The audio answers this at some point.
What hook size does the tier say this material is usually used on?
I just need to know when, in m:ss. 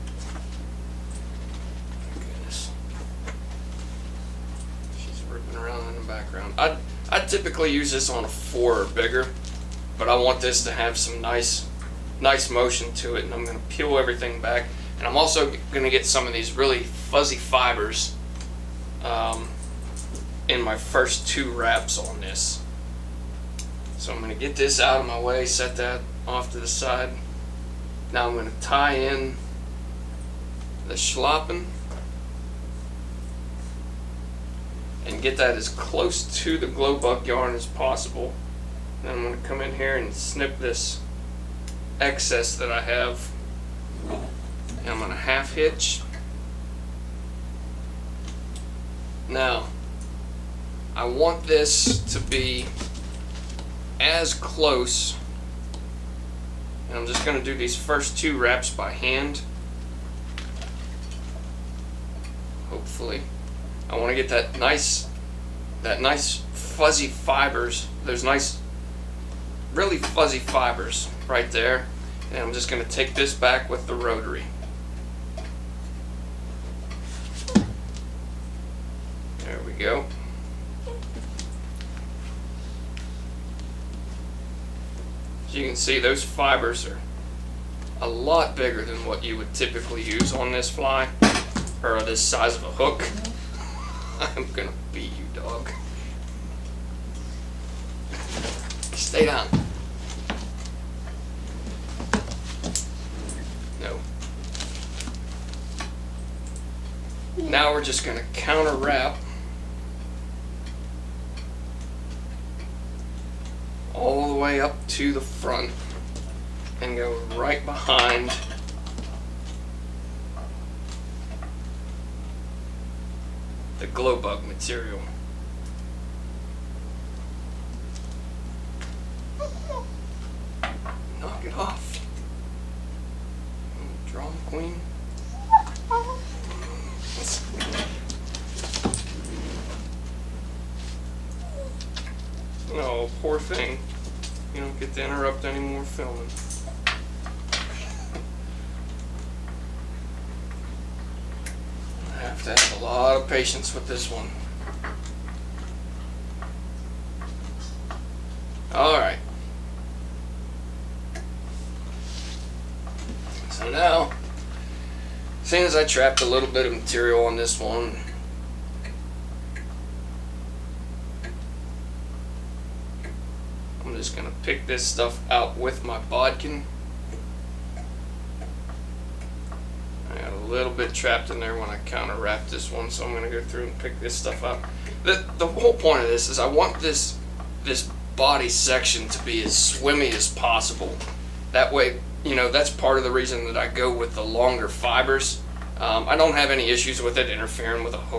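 0:08.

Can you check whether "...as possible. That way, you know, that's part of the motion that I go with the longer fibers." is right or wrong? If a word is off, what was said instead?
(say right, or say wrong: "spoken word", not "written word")
wrong: "reason", not "motion".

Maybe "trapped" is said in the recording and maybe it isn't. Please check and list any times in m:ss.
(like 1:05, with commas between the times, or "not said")
2:45, 3:00.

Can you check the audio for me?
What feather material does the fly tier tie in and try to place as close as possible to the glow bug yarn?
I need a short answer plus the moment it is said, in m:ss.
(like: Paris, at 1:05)
schlappen, at 0:30.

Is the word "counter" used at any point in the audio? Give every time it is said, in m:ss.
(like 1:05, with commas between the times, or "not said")
1:48.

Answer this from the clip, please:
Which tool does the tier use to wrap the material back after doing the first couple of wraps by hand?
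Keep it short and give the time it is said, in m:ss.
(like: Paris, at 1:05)
rotary, at 1:13.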